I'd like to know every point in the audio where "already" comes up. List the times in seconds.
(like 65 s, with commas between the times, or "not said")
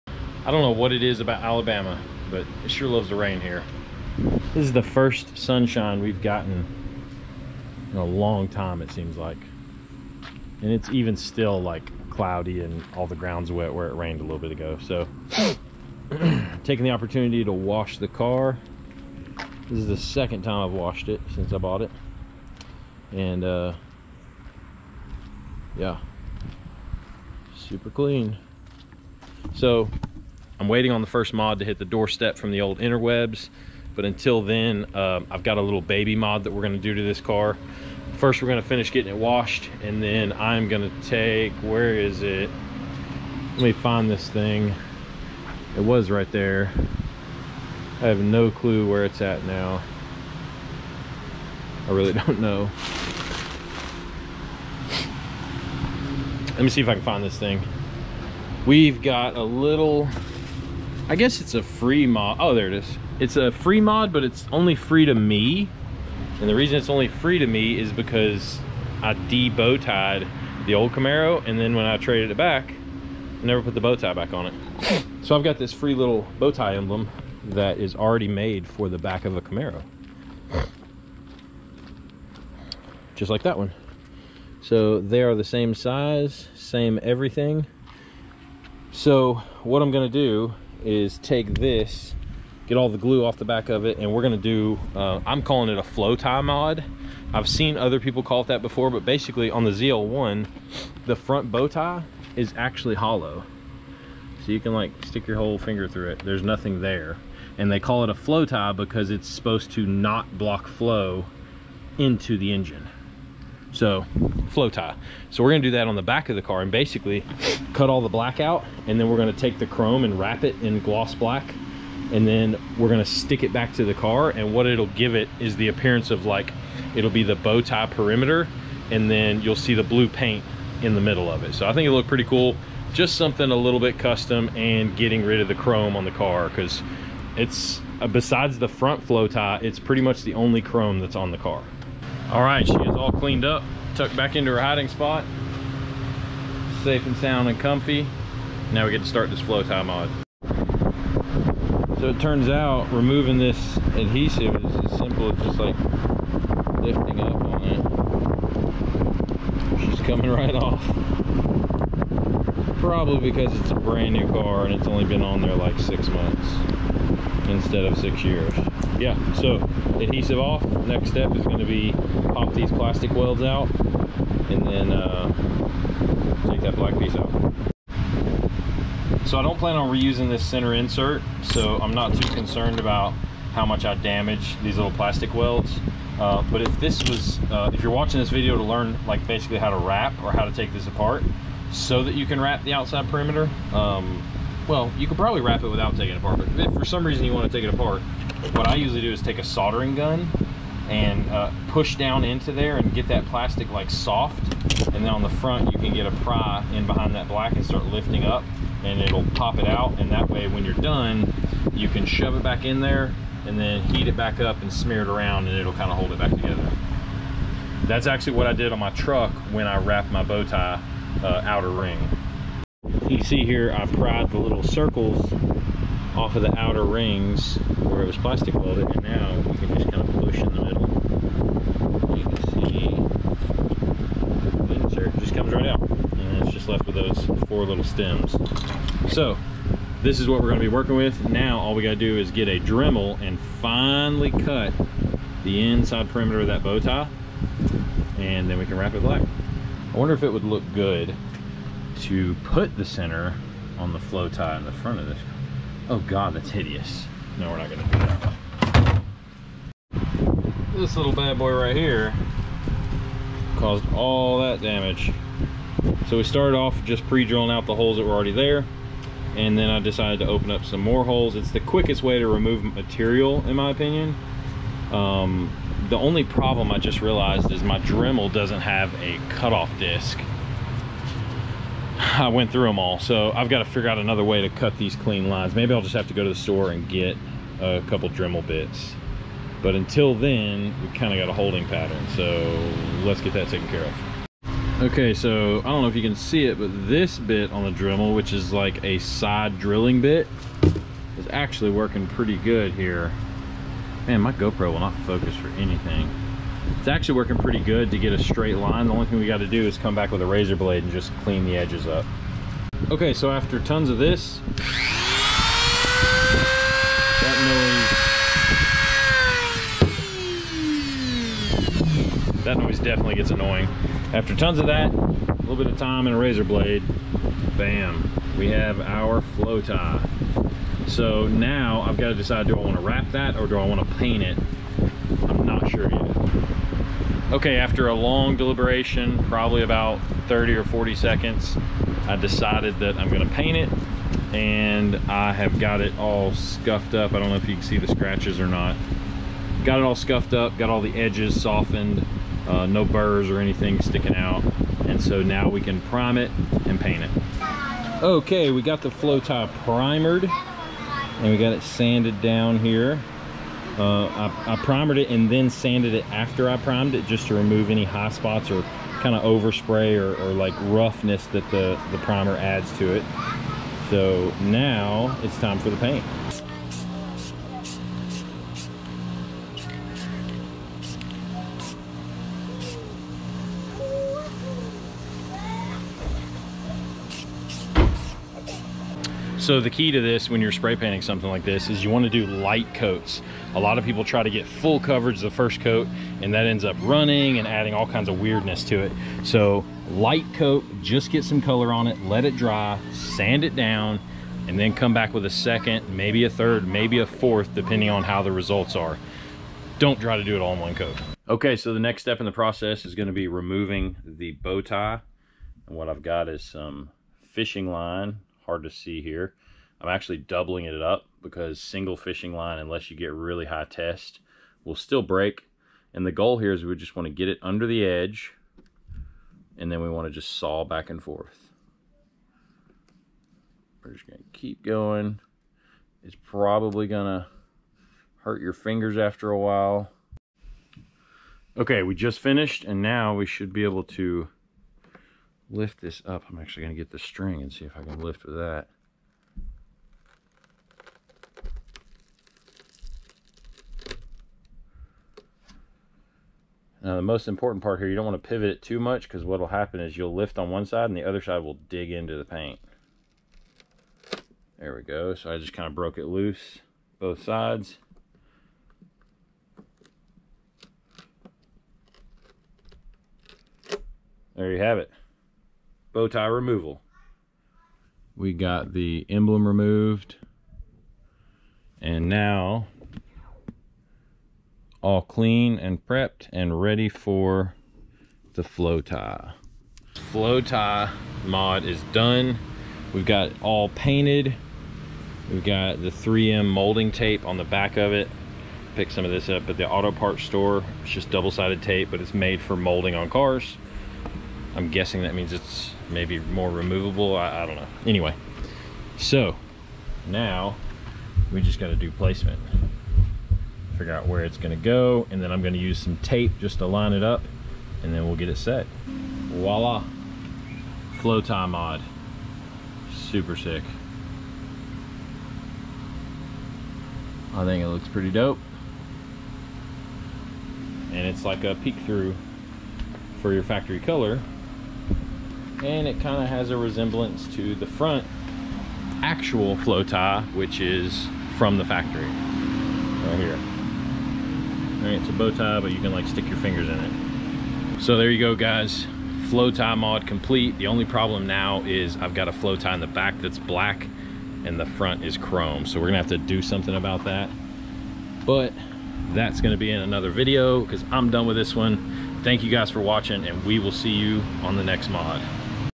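77 s, 268 s.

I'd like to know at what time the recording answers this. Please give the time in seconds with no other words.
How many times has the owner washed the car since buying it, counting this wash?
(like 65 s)
19 s.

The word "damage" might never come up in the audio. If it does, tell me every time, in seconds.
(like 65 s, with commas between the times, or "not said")
183 s, 264 s.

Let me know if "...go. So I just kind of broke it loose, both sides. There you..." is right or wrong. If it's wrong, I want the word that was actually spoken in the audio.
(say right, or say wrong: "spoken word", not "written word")
right.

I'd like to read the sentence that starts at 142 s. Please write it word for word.
All right, she is all cleaned up, tucked back into her hiding spot.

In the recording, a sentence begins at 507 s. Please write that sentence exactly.
Anyway, so now we just got to do placement.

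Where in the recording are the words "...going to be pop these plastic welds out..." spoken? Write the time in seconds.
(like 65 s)
171 s.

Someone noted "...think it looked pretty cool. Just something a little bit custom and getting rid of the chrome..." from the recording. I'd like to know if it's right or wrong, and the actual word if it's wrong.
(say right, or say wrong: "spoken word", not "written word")
right.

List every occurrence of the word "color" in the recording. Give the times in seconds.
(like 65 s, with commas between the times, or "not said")
401 s, 533 s.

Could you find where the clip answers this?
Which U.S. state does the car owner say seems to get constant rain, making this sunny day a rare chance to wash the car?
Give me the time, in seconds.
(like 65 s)
1 s.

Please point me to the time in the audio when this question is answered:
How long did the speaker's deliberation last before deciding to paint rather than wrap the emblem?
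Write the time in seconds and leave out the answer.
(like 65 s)
340 s.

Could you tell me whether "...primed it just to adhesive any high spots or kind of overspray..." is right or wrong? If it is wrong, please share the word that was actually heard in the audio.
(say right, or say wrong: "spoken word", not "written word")
wrong: "remove", not "adhesive".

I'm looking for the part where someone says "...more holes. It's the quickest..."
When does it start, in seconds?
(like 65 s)
270 s.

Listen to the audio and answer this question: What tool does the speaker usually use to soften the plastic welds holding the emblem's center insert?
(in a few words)
Soldering gun.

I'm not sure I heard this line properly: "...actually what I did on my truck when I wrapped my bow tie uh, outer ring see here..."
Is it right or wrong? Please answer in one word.
right.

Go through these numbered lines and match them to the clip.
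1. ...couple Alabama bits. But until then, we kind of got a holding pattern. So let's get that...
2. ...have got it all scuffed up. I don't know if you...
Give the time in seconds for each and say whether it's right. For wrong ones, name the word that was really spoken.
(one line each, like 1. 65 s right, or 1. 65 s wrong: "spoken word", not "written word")
1. 287 s wrong: "Dremel", not "Alabama"
2. 345 s right.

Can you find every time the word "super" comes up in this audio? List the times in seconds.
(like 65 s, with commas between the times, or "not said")
27 s, 522 s.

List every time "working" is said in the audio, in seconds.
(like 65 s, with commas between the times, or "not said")
240 s, 301 s, 307 s.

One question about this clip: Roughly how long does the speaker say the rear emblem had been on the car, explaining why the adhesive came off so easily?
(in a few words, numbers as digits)
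6 months.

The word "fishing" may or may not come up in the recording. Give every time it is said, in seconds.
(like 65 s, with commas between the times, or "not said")
417 s, 421 s.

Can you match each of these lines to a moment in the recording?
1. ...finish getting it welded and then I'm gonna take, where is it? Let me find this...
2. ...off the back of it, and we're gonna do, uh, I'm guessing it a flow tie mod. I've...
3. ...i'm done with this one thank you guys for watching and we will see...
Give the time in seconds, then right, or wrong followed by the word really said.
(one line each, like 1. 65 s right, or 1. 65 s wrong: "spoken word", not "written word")
1. 38 s wrong: "washed", not "welded"
2. 93 s wrong: "calling", not "guessing"
3. 560 s right.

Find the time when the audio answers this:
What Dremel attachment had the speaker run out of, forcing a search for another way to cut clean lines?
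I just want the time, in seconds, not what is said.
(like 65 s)
279 s.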